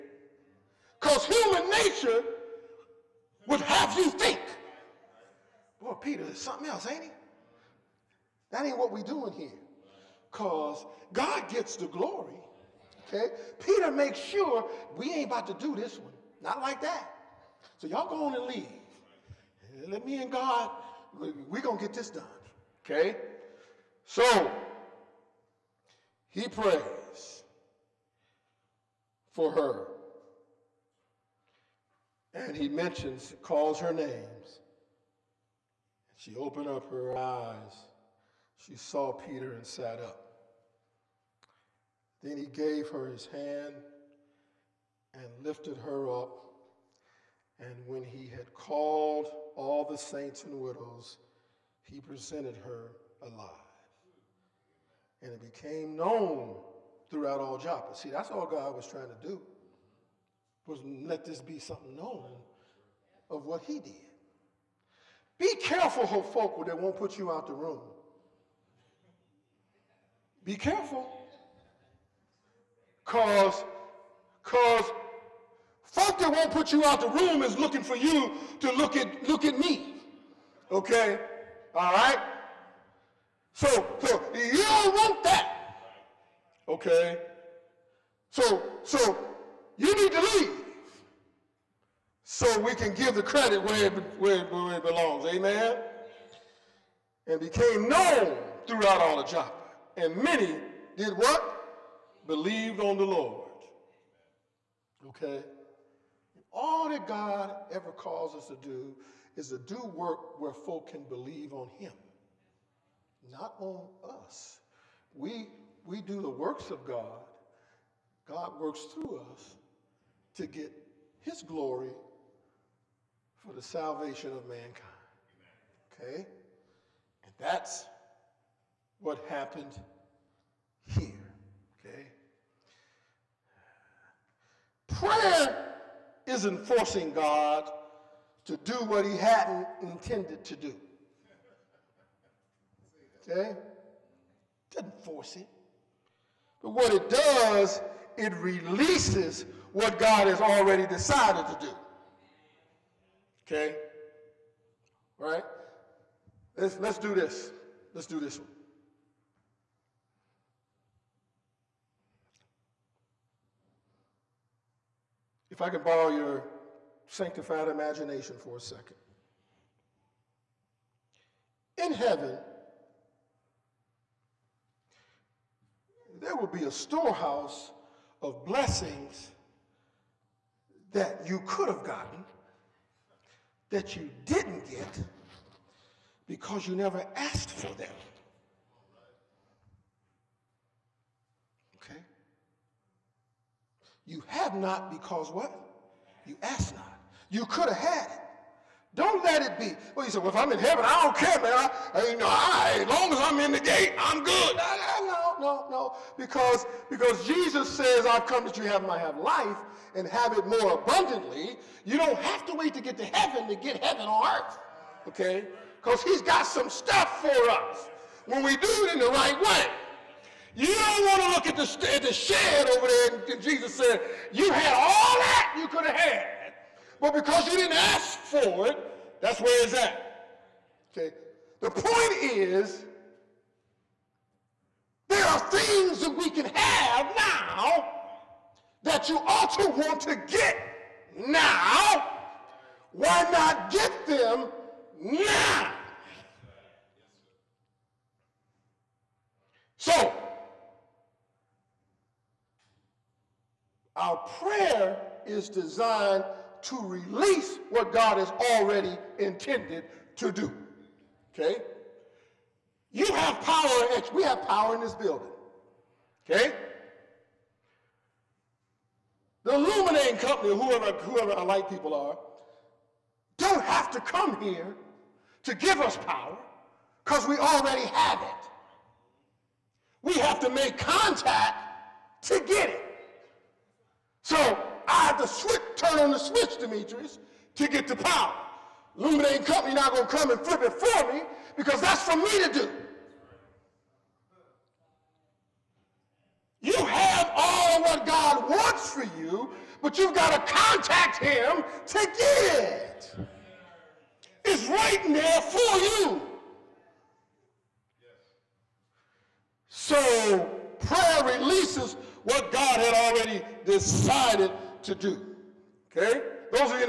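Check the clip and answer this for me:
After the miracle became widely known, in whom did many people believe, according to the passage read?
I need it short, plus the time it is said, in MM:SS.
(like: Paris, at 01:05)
The Lord, at 01:42.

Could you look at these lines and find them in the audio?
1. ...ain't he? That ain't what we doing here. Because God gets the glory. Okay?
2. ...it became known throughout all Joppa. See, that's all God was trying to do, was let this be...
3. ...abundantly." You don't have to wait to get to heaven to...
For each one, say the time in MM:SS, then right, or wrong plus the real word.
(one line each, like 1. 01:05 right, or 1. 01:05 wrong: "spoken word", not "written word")
1. 00:06 right
2. 00:55 right
3. 03:30 right.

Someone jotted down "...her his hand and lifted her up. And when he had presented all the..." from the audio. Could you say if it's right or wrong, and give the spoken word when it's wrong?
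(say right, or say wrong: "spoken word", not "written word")
wrong: "called", not "presented".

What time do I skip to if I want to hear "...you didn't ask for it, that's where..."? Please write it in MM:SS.
03:47.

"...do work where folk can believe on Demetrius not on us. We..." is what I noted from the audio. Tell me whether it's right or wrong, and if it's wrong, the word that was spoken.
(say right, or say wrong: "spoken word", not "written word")
wrong: "Him", not "Demetrius".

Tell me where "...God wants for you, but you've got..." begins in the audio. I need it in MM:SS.
04:58.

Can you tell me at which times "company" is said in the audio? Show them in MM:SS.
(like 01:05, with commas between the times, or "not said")
04:30, 04:49.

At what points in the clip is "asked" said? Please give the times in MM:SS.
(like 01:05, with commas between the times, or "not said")
03:07, 03:16.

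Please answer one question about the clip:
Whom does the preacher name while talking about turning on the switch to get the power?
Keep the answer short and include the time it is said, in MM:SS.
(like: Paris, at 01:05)
Demetrius, at 04:46.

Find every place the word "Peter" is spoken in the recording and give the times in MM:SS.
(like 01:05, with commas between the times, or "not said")
00:05, 00:13, 00:39.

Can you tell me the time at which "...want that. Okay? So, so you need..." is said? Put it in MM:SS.
01:24.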